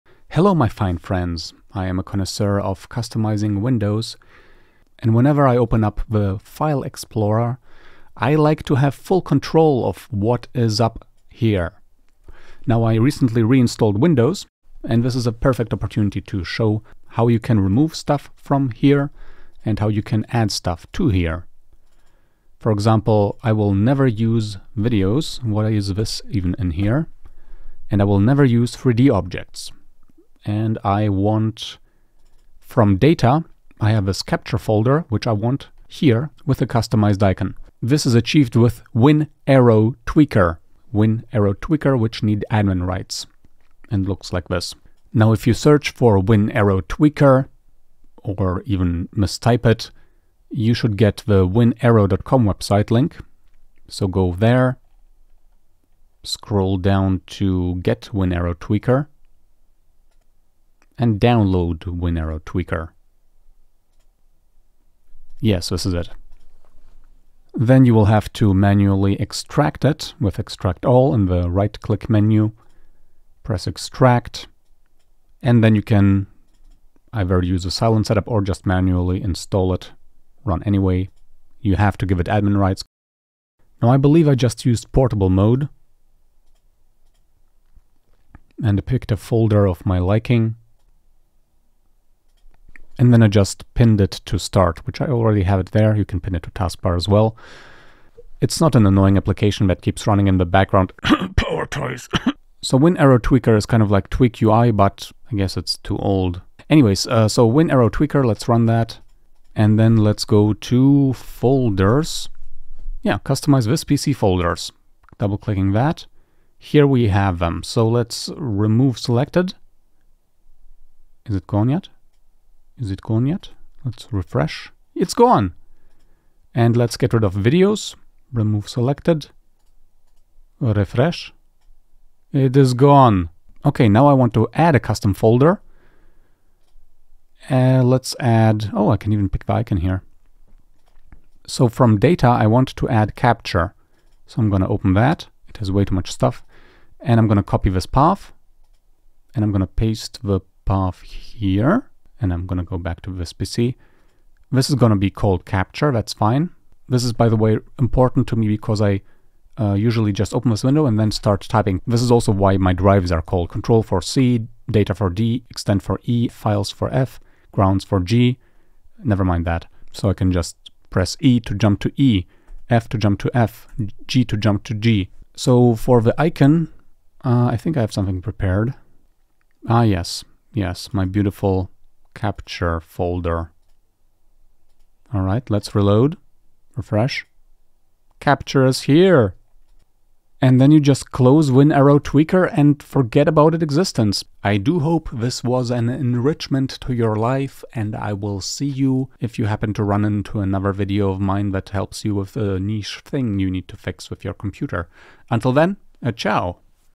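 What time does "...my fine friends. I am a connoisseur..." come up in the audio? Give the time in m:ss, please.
0:00.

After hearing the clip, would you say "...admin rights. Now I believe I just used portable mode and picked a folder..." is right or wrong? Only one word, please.
right.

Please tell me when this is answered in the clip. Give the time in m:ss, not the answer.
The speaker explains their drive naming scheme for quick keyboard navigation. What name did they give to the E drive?
2:45.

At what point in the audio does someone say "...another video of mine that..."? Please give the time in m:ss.
3:20.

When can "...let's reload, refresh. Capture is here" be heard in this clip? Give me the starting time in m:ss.
3:05.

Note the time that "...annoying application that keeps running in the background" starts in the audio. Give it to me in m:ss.
1:38.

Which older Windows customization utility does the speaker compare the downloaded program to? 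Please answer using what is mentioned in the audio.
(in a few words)
Tweak UI.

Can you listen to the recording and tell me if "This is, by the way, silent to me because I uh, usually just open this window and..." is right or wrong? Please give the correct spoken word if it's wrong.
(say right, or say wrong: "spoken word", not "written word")
wrong: "important", not "silent".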